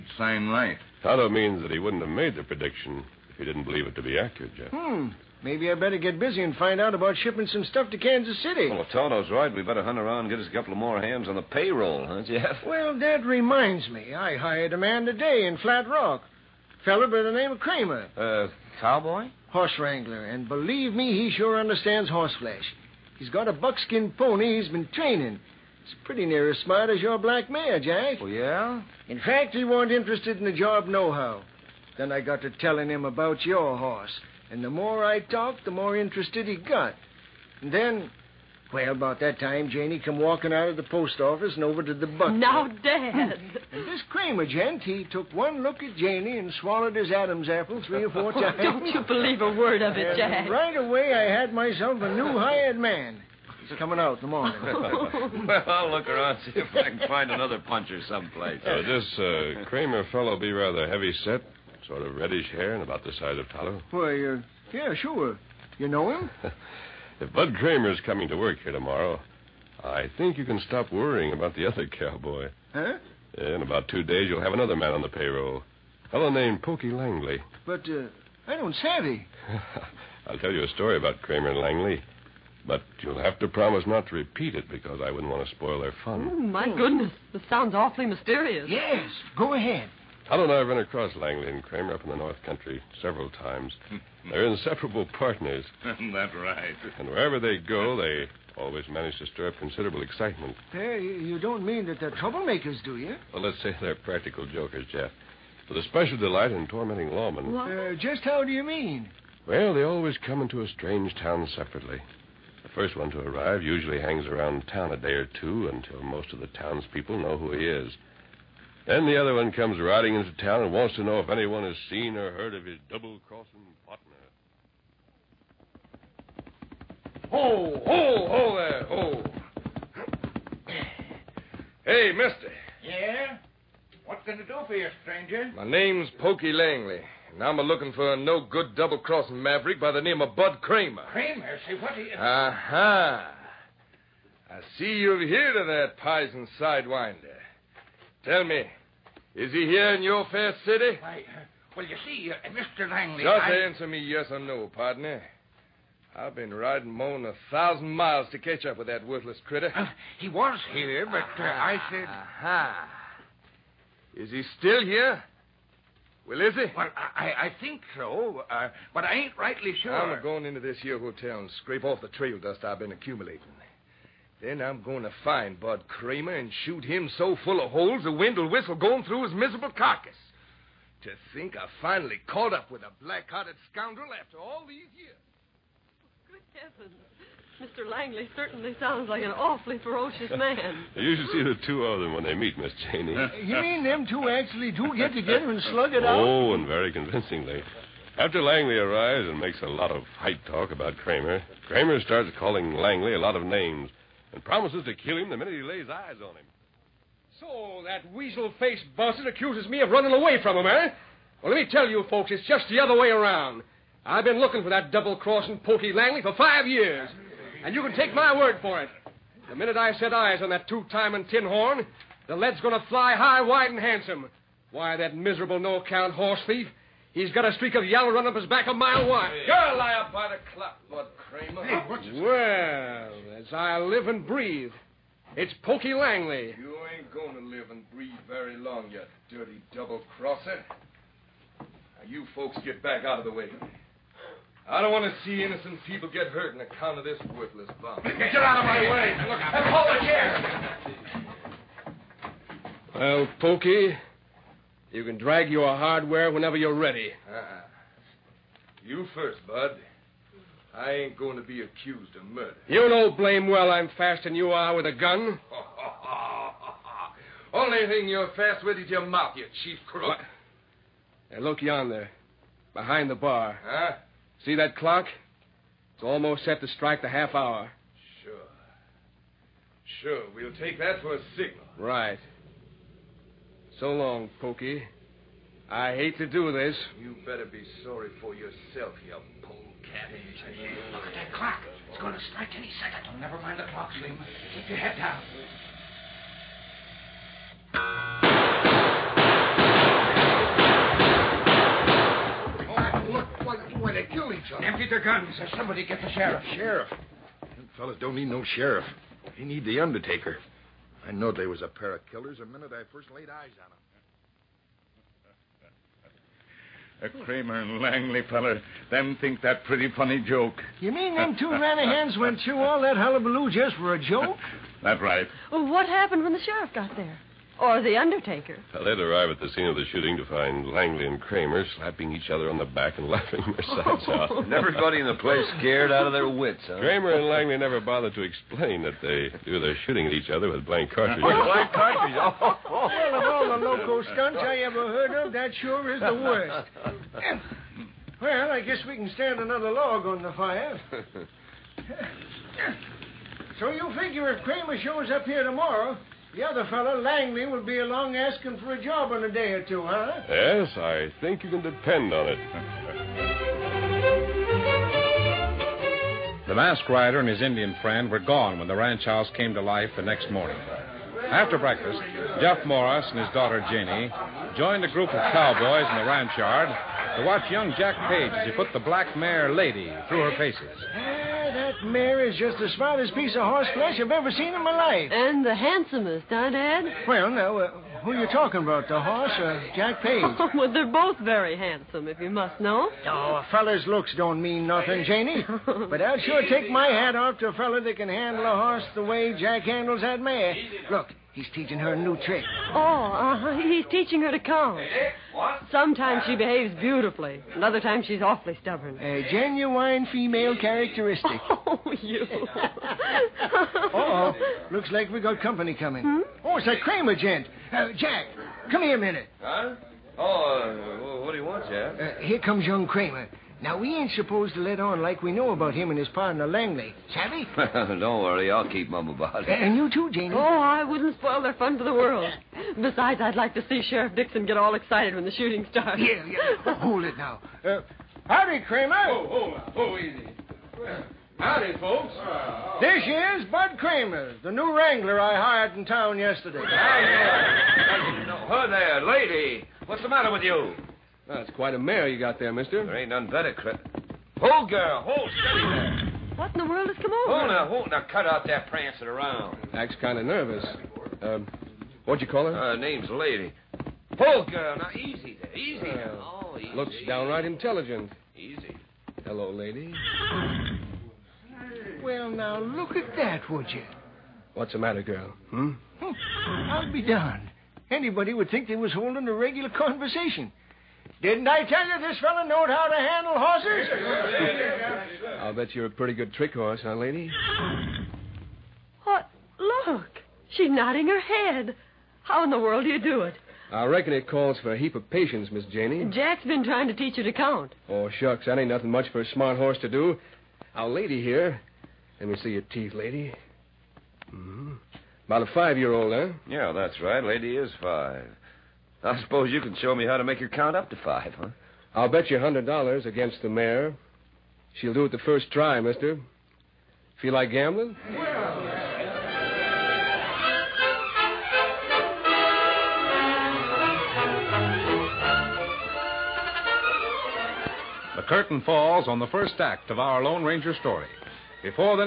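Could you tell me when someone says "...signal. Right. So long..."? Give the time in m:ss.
4:41.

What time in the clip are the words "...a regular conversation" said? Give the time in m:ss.
7:59.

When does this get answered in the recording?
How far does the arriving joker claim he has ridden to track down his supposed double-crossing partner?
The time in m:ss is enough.
2:36.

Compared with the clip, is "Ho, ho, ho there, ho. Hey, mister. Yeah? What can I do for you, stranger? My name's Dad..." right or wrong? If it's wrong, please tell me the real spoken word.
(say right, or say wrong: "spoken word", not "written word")
wrong: "Pokey", not "Dad".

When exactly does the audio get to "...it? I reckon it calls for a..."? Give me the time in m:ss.
8:13.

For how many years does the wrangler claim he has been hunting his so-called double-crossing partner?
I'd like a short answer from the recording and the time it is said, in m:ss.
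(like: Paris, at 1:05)
5, at 3:36.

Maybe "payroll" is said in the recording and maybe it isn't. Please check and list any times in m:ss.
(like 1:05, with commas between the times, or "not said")
0:11, 1:15.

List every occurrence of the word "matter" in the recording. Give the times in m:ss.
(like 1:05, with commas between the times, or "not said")
7:30, 7:54.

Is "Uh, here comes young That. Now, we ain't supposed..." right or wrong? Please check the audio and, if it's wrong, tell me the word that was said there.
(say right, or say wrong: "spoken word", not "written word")
wrong: "Kramer", not "That".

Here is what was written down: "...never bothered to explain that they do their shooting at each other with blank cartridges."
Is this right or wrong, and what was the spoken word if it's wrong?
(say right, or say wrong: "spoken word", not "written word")
right.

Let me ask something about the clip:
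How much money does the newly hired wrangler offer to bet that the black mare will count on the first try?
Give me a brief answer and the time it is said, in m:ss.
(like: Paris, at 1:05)
$100, at 8:32.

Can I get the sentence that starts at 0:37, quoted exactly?
And then, well, about that time, Janey come walking out of the post office and over to the butler.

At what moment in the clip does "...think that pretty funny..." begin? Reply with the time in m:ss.
5:19.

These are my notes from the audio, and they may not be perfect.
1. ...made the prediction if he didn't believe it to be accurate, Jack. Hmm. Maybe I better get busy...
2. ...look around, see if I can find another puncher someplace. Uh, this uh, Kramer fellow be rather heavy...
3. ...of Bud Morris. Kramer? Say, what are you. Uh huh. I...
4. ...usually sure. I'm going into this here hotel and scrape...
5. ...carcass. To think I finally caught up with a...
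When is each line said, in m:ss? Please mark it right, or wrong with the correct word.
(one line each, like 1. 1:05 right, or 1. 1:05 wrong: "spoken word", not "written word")
1. 0:02 wrong: "Jeff", not "Jack"
2. 0:55 right
3. 2:20 wrong: "Kramer", not "Morris"
4. 2:49 wrong: "rightly", not "usually"
5. 2:59 right.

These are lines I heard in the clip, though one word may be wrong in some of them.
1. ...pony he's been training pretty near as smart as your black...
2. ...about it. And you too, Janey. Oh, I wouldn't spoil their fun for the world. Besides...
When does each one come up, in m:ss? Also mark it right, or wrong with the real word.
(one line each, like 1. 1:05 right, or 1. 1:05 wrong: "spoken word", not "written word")
1. 0:24 right
2. 7:09 right.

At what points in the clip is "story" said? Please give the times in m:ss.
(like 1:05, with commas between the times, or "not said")
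1:20, 8:50.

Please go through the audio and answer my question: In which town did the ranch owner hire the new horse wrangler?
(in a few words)
Flat Rock.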